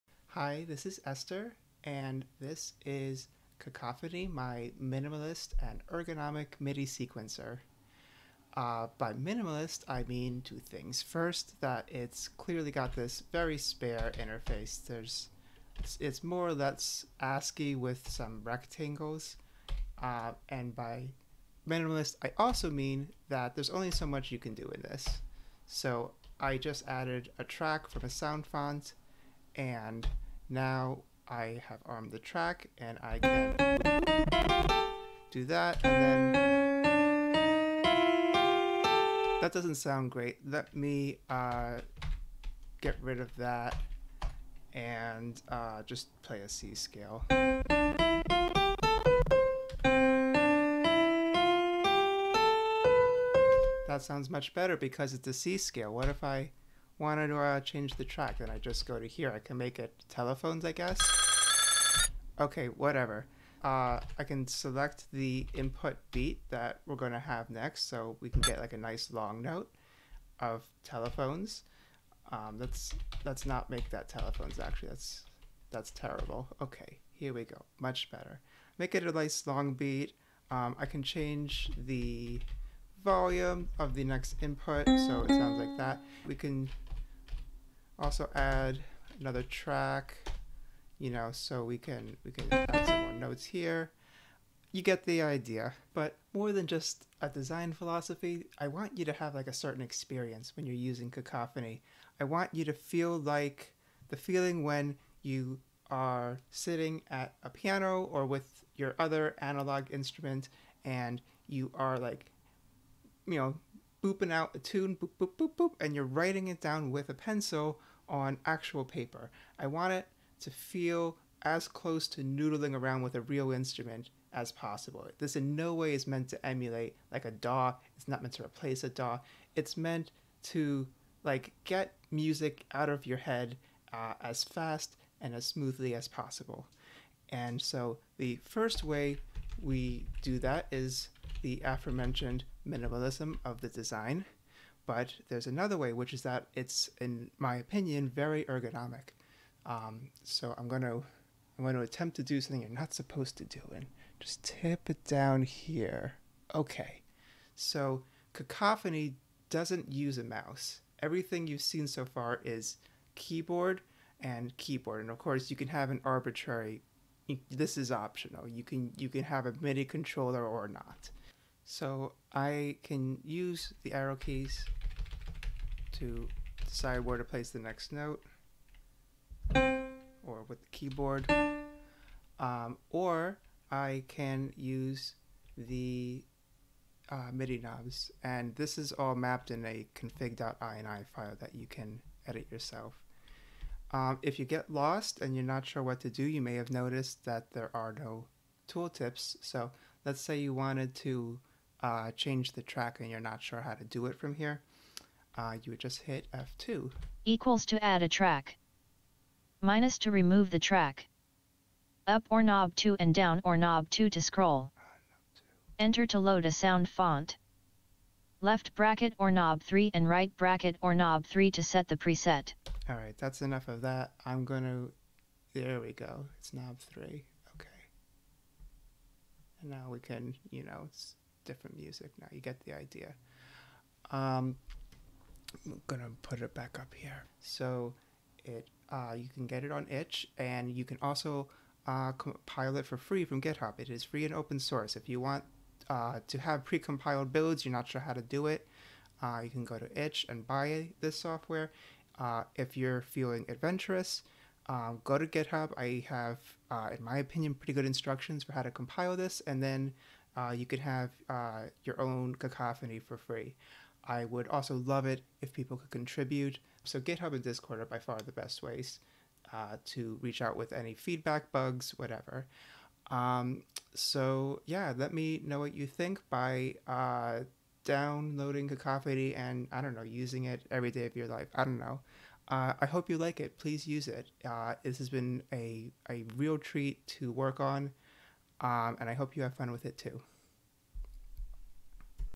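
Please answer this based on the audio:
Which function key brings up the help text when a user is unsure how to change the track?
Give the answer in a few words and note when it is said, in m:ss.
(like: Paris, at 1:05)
F2, at 3:26.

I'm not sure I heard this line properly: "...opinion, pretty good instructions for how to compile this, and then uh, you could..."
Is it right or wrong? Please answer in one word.
right.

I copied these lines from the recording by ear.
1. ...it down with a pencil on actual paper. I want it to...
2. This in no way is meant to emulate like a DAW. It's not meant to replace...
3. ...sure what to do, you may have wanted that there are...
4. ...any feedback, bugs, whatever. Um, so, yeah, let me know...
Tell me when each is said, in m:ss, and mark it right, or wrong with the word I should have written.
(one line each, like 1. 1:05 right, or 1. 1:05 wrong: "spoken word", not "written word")
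1. 1:56 right
2. 2:05 right
3. 3:15 wrong: "noticed", not "wanted"
4. 4:30 right.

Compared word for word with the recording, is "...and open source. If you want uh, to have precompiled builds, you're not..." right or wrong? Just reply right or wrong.
right.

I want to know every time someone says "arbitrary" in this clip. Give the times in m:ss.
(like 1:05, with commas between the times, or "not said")
2:46.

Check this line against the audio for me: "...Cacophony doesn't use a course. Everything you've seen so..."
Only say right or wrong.
wrong.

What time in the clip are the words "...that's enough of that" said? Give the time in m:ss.
3:43.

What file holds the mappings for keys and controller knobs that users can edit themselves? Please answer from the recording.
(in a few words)
config.ini.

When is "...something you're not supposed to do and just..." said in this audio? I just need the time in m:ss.
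2:32.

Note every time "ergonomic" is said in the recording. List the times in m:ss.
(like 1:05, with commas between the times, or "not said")
0:05, 2:28.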